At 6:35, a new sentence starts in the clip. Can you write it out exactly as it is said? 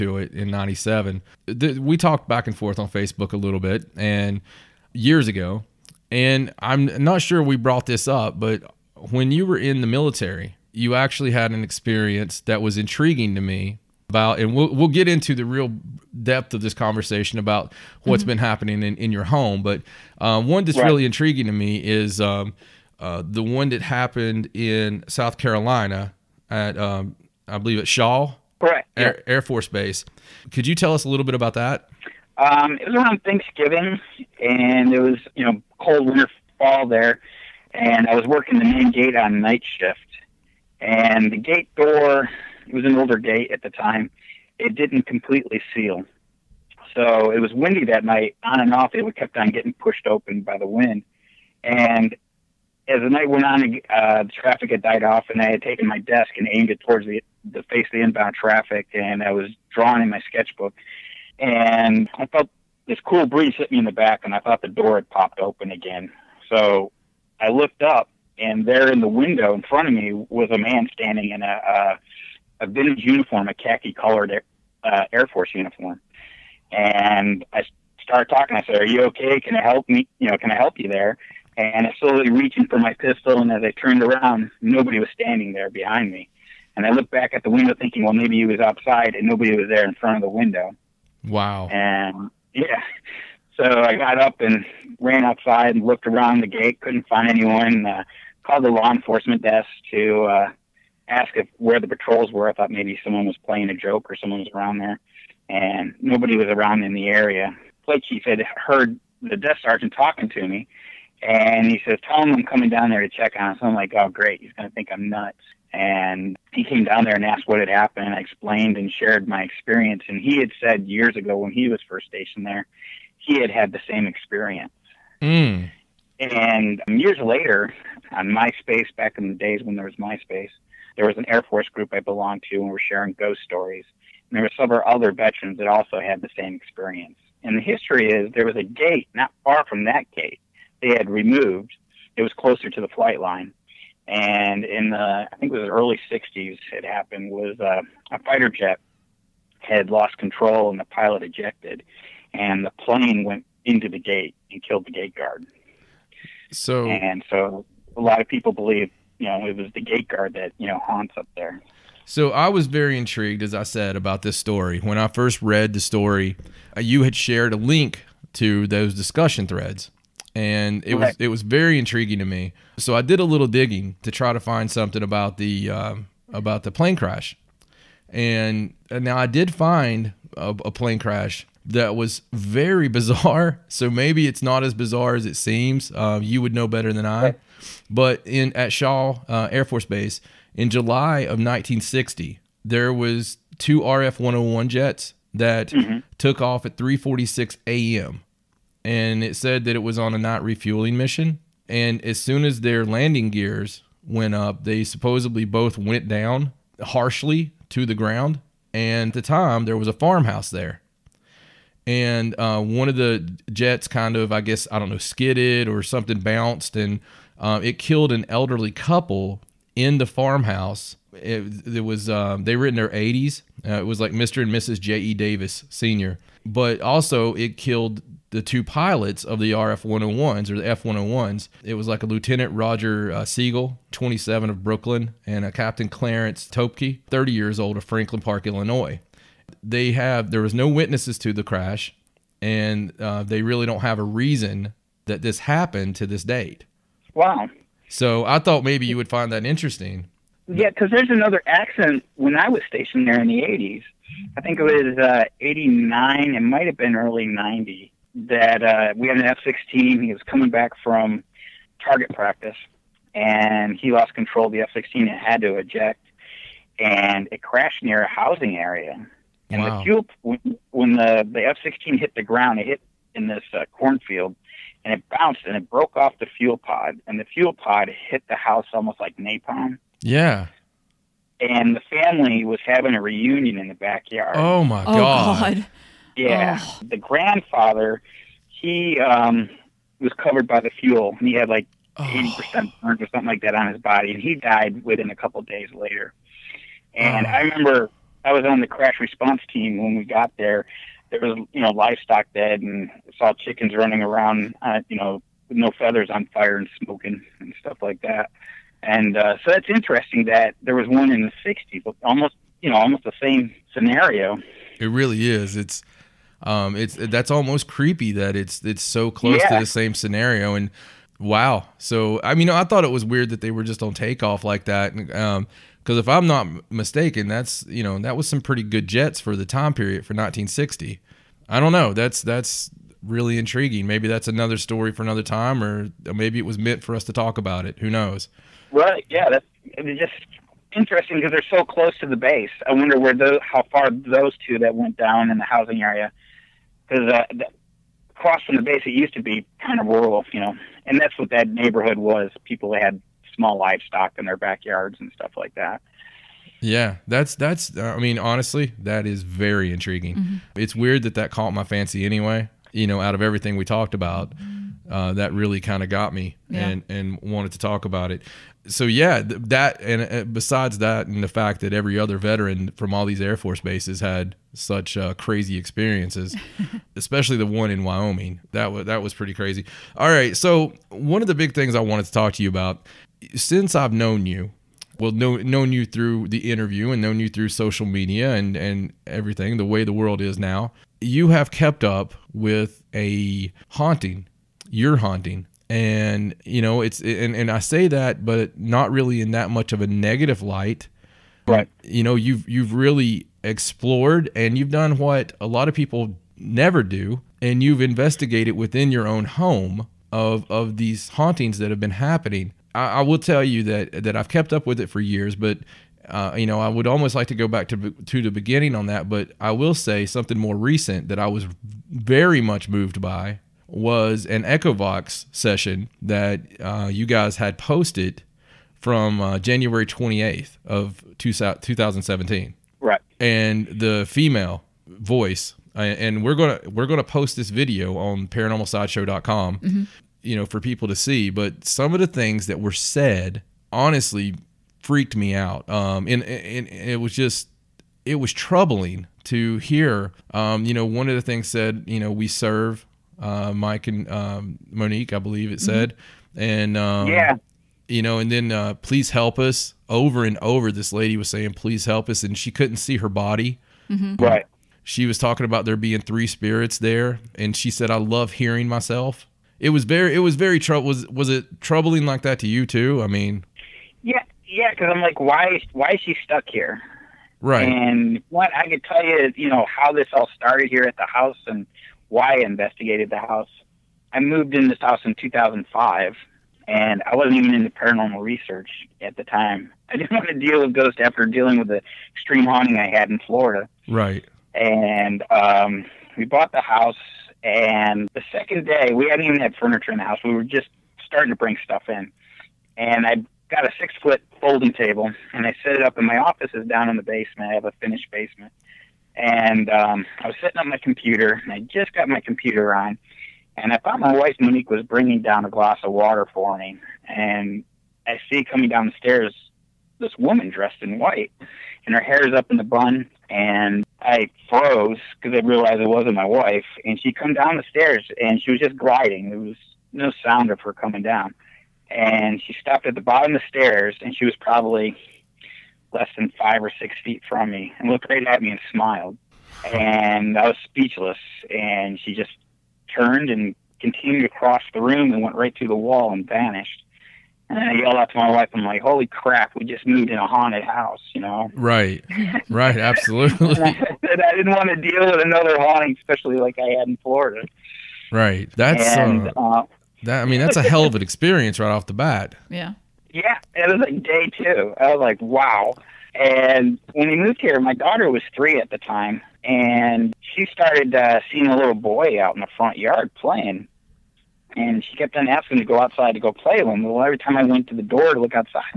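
And, you know, it's, and, and I say that, but not really in that much of a negative light.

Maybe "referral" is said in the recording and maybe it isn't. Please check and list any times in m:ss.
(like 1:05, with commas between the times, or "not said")
not said.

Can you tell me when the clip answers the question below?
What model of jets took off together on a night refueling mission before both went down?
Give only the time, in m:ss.
3:13.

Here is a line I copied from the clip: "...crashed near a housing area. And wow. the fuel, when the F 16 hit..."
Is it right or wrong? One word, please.
right.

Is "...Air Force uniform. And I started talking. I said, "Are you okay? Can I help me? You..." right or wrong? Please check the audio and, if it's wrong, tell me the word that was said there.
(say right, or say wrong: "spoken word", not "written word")
right.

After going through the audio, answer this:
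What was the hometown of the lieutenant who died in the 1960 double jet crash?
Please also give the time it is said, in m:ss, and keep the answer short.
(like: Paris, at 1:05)
Brooklyn, at 3:54.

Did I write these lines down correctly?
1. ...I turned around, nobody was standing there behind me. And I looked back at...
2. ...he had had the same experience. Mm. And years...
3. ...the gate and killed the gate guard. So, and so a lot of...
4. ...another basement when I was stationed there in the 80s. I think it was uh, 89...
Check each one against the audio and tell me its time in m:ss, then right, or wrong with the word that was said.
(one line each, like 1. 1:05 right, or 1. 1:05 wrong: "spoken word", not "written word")
1. 1:23 right
2. 2:03 right
3. 2:33 right
4. 4:11 wrong: "accident", not "basement".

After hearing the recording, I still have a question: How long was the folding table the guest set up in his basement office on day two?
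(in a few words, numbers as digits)
6 feet.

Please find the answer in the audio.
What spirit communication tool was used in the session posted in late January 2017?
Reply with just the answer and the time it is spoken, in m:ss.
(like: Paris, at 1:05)
Echovox, at 7:04.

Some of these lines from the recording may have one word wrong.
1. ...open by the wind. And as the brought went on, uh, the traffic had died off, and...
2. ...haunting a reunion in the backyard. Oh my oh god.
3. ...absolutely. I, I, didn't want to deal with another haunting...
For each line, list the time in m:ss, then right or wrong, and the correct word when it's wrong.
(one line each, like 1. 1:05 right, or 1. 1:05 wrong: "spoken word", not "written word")
1. 0:50 wrong: "night", not "brought"
2. 4:42 wrong: "having", not "haunting"
3. 9:12 right.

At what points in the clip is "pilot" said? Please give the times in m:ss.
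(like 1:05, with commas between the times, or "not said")
2:30, 3:48.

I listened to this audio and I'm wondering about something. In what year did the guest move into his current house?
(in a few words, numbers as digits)
2005.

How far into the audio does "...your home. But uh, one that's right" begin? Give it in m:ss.
0:19.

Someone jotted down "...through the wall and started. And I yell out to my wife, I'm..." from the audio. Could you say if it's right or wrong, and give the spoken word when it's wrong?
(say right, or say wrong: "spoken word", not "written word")
wrong: "vanished", not "started".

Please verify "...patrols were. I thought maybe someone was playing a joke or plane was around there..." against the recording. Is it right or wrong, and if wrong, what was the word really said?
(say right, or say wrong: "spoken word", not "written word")
wrong: "someone", not "plane".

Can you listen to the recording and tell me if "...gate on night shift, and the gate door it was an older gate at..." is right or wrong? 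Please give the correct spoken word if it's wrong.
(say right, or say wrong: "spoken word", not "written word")
right.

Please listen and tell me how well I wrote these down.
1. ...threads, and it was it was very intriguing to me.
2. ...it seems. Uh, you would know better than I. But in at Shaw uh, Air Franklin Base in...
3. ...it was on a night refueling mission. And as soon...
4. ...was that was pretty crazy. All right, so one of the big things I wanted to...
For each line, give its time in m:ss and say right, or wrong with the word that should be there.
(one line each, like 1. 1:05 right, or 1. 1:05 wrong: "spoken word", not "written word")
1. 2:49 right
2. 3:05 wrong: "Force", not "Franklin"
3. 3:19 right
4. 6:18 right.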